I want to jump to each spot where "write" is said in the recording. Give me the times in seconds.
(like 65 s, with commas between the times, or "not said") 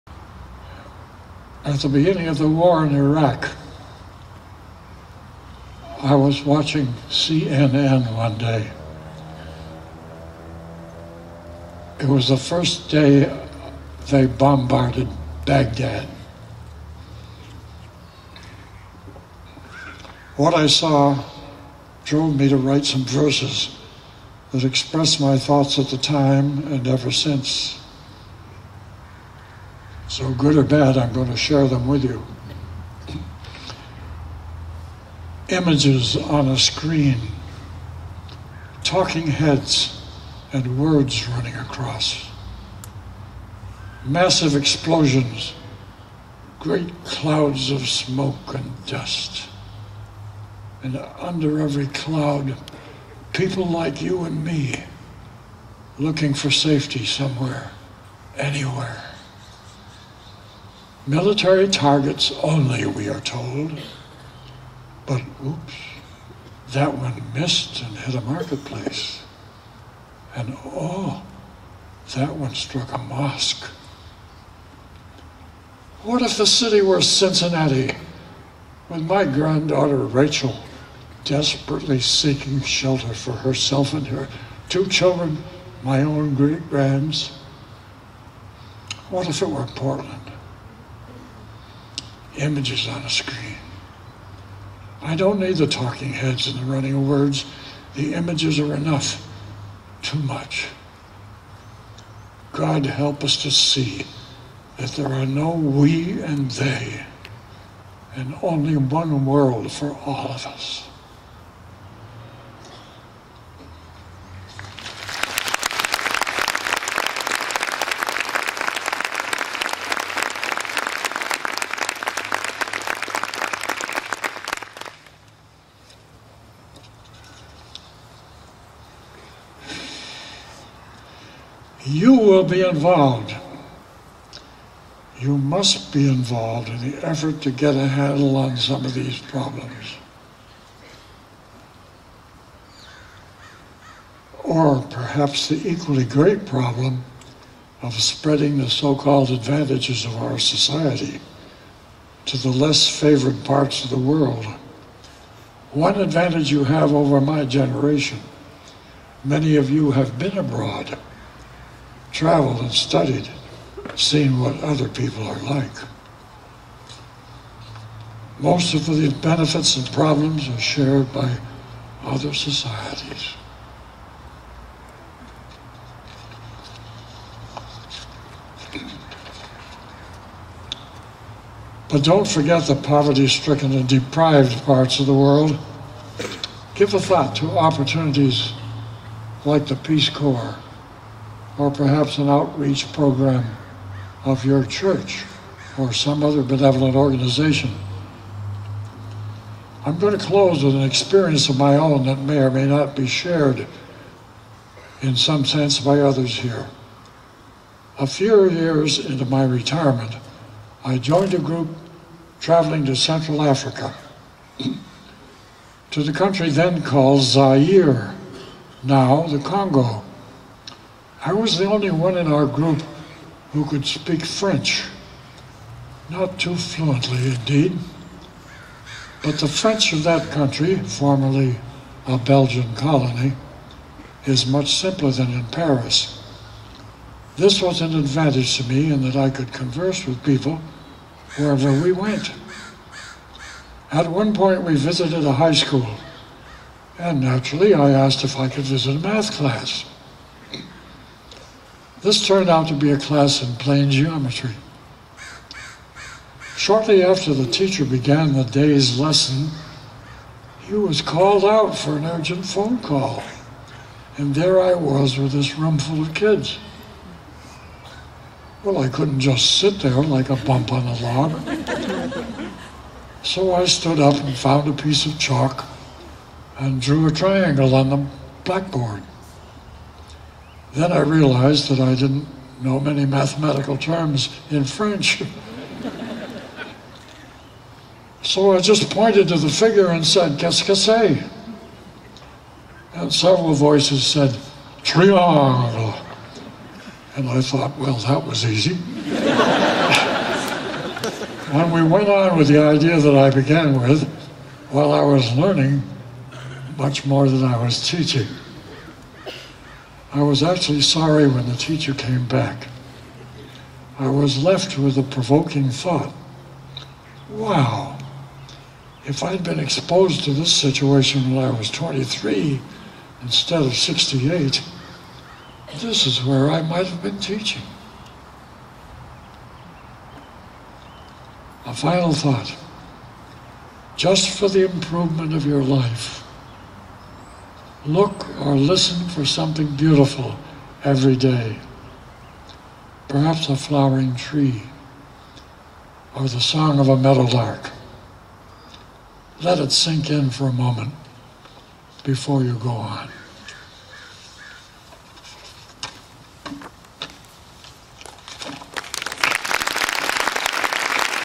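22 s.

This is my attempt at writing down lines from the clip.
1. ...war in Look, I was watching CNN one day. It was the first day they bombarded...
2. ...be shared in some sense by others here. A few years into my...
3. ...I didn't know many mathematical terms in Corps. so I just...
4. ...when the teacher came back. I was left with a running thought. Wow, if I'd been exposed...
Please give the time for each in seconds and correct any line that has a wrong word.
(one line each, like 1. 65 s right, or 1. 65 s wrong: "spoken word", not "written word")
1. 2 s wrong: "Iraq", not "Look"
2. 202 s right
3. 281 s wrong: "French", not "Corps"
4. 311 s wrong: "provoking", not "running".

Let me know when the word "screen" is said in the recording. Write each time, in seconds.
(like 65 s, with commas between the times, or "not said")
36 s, 93 s.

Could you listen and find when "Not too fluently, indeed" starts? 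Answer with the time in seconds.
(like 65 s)
226 s.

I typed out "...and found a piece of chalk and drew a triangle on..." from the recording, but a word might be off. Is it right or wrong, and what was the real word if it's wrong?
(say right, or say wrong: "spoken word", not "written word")
right.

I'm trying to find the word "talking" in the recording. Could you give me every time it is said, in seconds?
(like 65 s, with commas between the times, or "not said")
38 s, 95 s.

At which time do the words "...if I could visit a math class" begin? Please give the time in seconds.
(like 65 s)
248 s.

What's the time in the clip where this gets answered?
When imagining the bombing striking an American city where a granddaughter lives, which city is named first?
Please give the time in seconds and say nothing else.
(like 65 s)
77 s.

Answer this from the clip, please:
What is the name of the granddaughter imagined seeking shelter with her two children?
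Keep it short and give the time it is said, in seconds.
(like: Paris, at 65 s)
Rachel, at 79 s.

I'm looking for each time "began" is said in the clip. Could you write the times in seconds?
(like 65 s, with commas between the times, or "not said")
257 s, 303 s.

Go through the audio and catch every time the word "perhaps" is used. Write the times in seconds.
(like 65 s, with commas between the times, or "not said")
144 s, 191 s, 343 s.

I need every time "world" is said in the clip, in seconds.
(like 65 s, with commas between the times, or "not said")
109 s, 153 s, 185 s.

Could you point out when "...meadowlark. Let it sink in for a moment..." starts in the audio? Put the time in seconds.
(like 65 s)
346 s.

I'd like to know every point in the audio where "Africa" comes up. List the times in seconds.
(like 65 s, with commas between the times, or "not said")
213 s.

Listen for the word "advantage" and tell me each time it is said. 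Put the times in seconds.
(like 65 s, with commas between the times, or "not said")
149 s, 155 s, 237 s.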